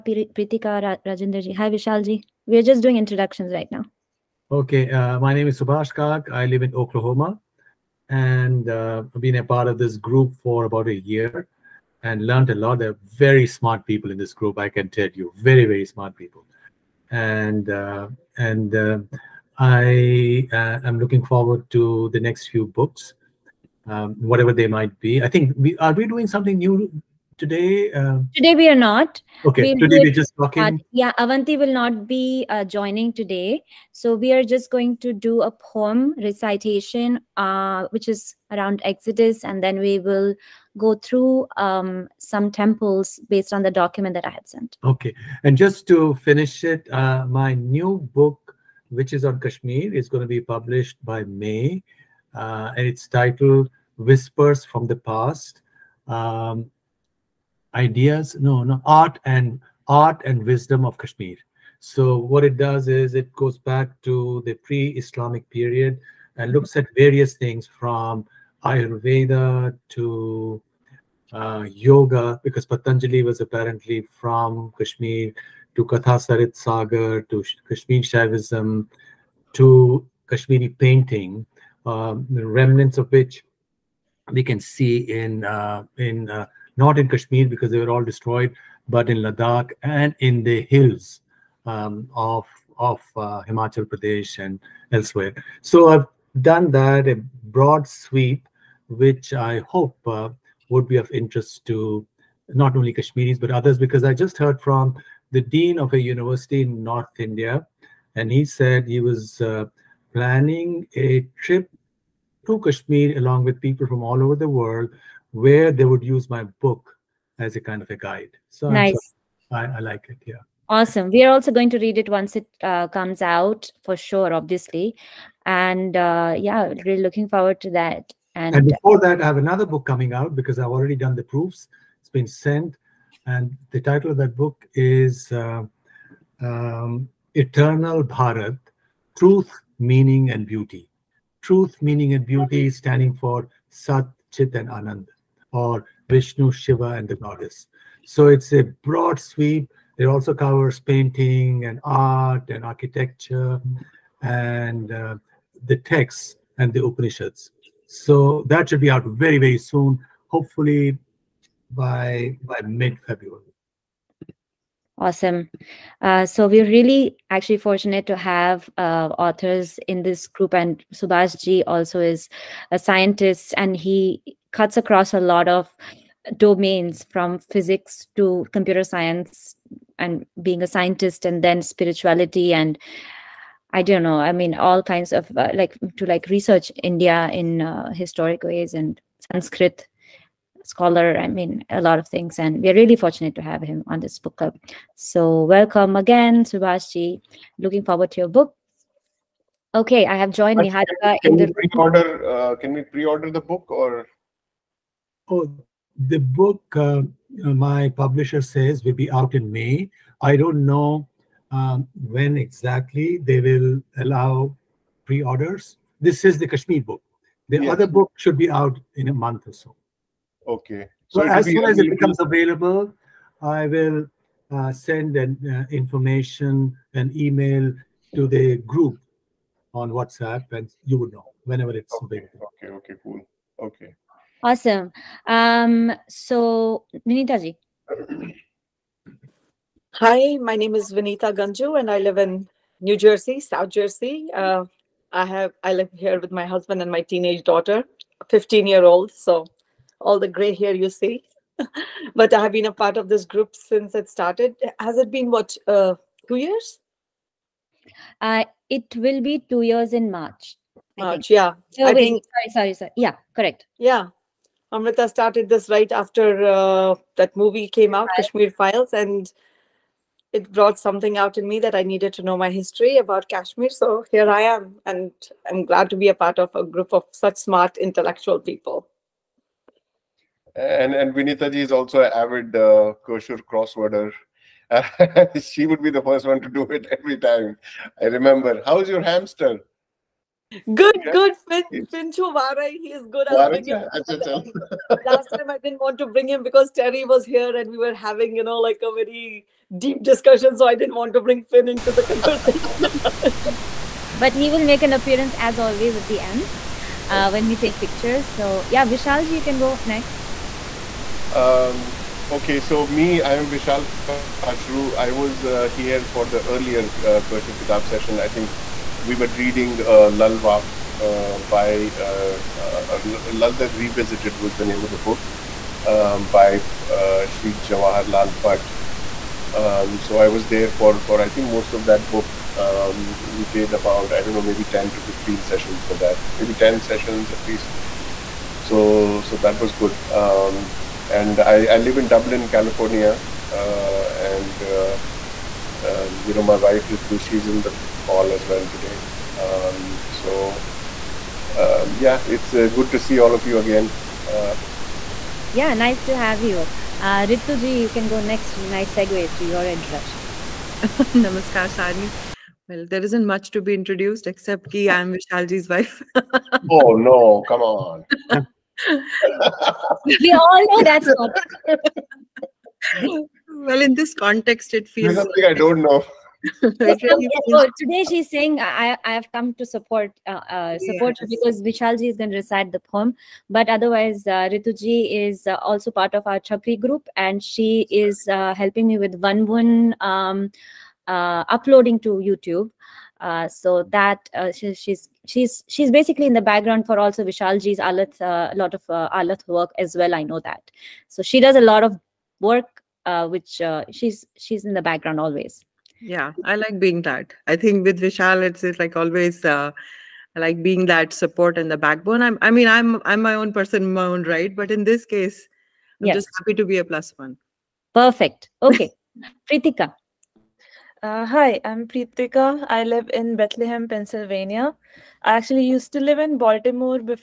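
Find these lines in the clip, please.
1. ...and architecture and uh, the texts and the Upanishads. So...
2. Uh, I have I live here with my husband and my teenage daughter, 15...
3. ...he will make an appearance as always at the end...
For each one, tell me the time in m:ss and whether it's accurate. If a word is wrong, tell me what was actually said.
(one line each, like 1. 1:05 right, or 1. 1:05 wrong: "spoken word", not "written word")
1. 2:32 right
2. 4:04 right
3. 5:04 right.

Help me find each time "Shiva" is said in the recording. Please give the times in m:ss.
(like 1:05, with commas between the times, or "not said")
2:26.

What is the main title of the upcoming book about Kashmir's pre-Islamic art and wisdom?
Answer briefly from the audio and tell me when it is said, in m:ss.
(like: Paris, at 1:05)
Whispers from the Past, at 0:54.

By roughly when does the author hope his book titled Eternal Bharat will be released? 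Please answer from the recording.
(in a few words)
mid February.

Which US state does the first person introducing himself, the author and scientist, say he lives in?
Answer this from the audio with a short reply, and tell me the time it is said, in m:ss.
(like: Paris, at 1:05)
Oklahoma, at 0:06.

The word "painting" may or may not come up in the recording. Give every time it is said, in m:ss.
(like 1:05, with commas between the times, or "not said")
1:20, 2:30.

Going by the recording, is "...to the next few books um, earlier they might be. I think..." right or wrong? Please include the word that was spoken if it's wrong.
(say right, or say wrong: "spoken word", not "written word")
wrong: "whatever", not "earlier".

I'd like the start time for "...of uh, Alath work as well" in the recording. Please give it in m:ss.
6:38.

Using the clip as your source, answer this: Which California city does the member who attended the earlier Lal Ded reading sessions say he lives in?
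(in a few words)
Dublin.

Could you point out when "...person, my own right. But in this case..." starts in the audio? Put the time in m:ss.
6:53.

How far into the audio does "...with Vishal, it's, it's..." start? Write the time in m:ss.
6:47.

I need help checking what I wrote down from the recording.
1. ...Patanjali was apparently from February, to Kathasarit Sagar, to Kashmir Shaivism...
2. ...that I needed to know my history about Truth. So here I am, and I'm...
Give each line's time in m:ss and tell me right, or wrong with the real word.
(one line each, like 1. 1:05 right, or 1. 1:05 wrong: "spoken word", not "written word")
1. 1:12 wrong: "Kashmir", not "February"
2. 4:31 wrong: "Kashmir", not "Truth".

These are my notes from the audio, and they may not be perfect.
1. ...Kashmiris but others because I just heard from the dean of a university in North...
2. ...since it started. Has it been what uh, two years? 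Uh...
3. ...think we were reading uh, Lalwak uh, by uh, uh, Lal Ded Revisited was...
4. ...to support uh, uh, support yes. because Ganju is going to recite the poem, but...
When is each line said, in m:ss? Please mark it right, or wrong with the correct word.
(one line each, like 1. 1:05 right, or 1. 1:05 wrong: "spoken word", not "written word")
1. 1:42 right
2. 4:13 right
3. 5:18 right
4. 6:19 wrong: "Vishalji", not "Ganju".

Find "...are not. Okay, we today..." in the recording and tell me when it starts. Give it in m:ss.
0:28.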